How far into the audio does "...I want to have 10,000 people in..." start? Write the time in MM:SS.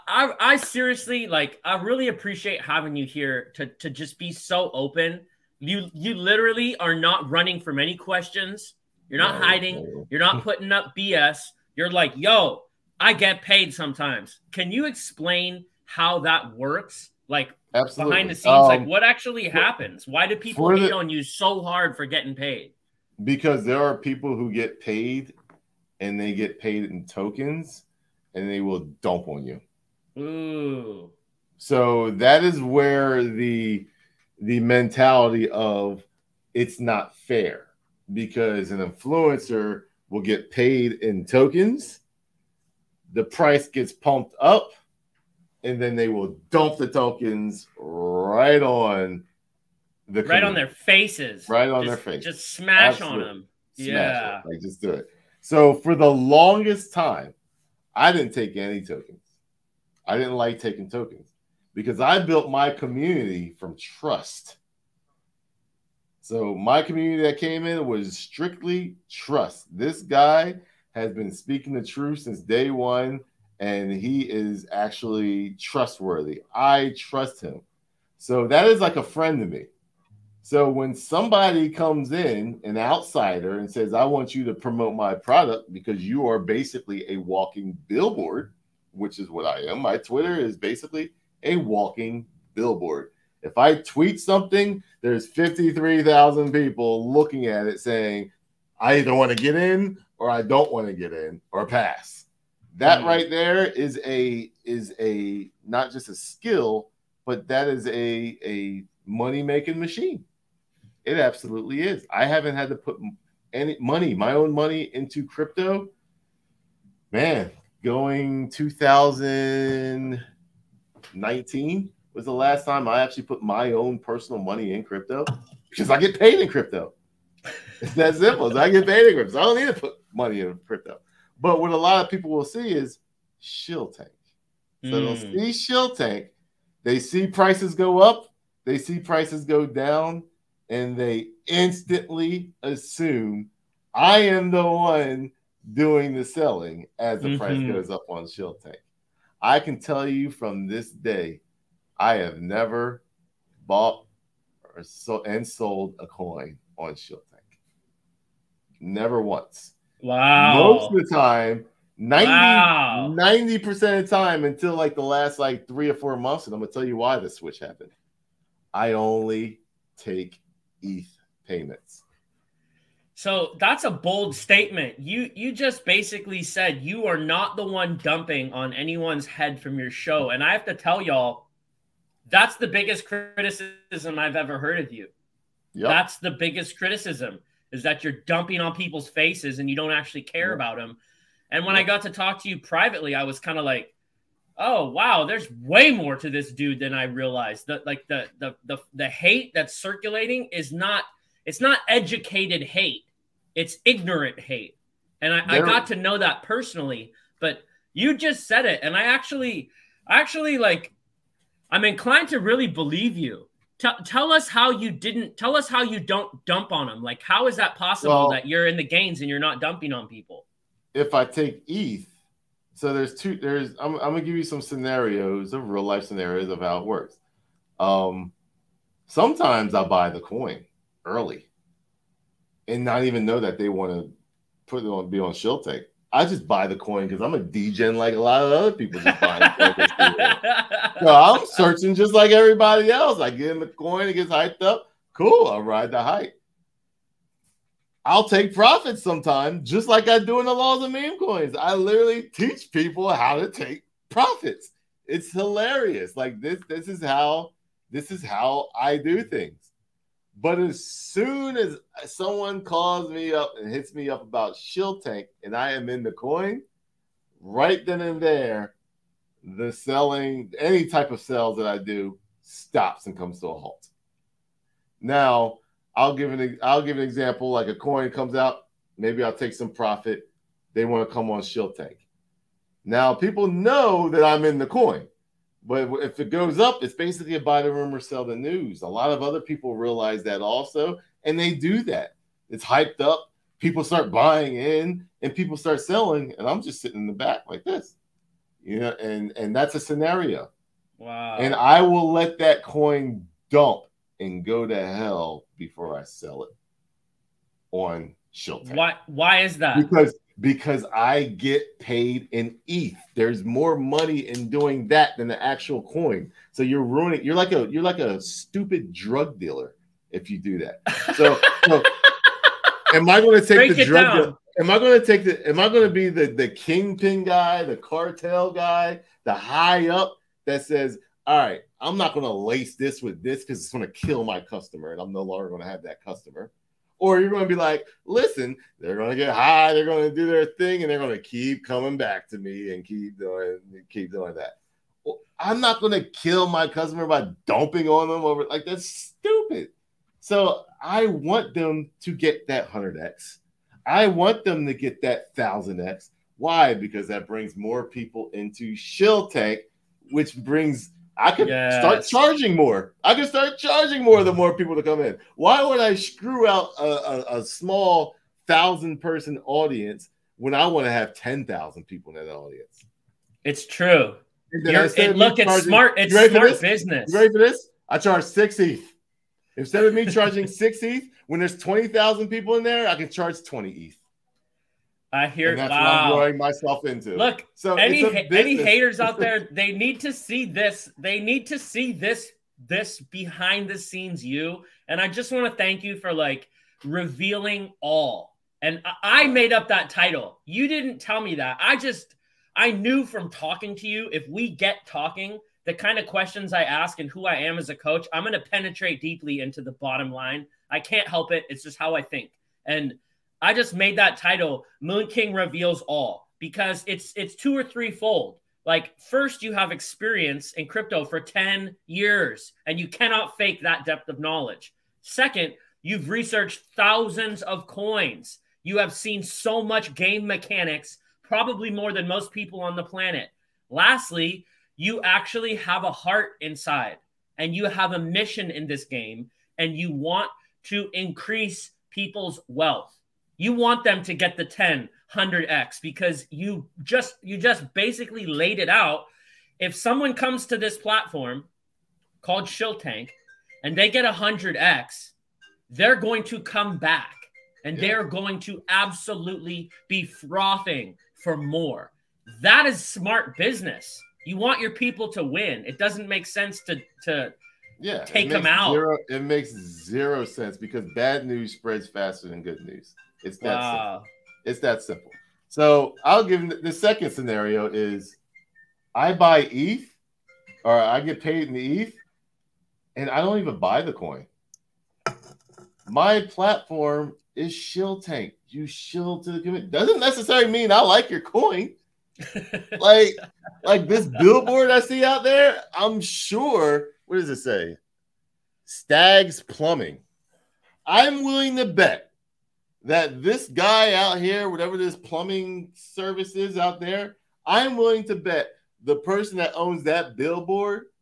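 06:10.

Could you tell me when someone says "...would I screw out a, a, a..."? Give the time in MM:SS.
06:05.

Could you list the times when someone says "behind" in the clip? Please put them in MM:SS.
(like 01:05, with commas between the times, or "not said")
00:18, 06:32.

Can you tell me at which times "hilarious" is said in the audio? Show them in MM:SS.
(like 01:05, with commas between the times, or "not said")
04:15.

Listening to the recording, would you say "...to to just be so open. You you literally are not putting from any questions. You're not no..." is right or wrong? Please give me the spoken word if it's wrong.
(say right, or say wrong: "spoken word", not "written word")
wrong: "running", not "putting".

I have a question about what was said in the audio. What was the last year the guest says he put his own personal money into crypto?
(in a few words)
2019.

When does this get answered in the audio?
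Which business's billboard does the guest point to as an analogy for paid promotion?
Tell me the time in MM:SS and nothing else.
08:18.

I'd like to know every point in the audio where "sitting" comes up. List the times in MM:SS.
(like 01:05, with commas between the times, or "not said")
04:56.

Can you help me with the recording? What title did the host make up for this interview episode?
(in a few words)
Moon King reveals all.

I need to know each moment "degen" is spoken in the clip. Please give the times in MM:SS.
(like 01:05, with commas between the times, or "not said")
03:57.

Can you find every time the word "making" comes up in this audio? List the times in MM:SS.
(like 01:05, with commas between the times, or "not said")
01:49.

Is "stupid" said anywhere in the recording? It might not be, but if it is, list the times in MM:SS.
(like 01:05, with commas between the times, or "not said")
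05:18, 05:48.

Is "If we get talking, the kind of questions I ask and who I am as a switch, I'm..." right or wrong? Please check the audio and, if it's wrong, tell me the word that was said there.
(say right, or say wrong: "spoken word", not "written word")
wrong: "coach", not "switch".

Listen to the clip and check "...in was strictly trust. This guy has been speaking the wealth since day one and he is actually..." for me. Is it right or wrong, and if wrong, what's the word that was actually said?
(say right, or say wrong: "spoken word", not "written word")
wrong: "truth", not "wealth".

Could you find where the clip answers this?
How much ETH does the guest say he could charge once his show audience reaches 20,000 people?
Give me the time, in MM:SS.
06:23.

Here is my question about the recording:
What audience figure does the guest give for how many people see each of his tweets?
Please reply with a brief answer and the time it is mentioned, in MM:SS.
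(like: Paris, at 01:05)
53,000, at 01:35.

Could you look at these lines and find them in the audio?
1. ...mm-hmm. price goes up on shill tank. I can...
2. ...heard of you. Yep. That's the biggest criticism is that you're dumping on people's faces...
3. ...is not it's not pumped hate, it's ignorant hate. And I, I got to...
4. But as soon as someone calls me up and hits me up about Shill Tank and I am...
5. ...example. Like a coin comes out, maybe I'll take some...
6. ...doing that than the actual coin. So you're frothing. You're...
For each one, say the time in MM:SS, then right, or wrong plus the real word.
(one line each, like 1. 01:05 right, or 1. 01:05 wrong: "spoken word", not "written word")
1. 02:27 right
2. 03:04 right
3. 03:20 wrong: "educated", not "pumped"
4. 04:20 right
5. 04:37 right
6. 05:14 wrong: "ruining", not "frothing".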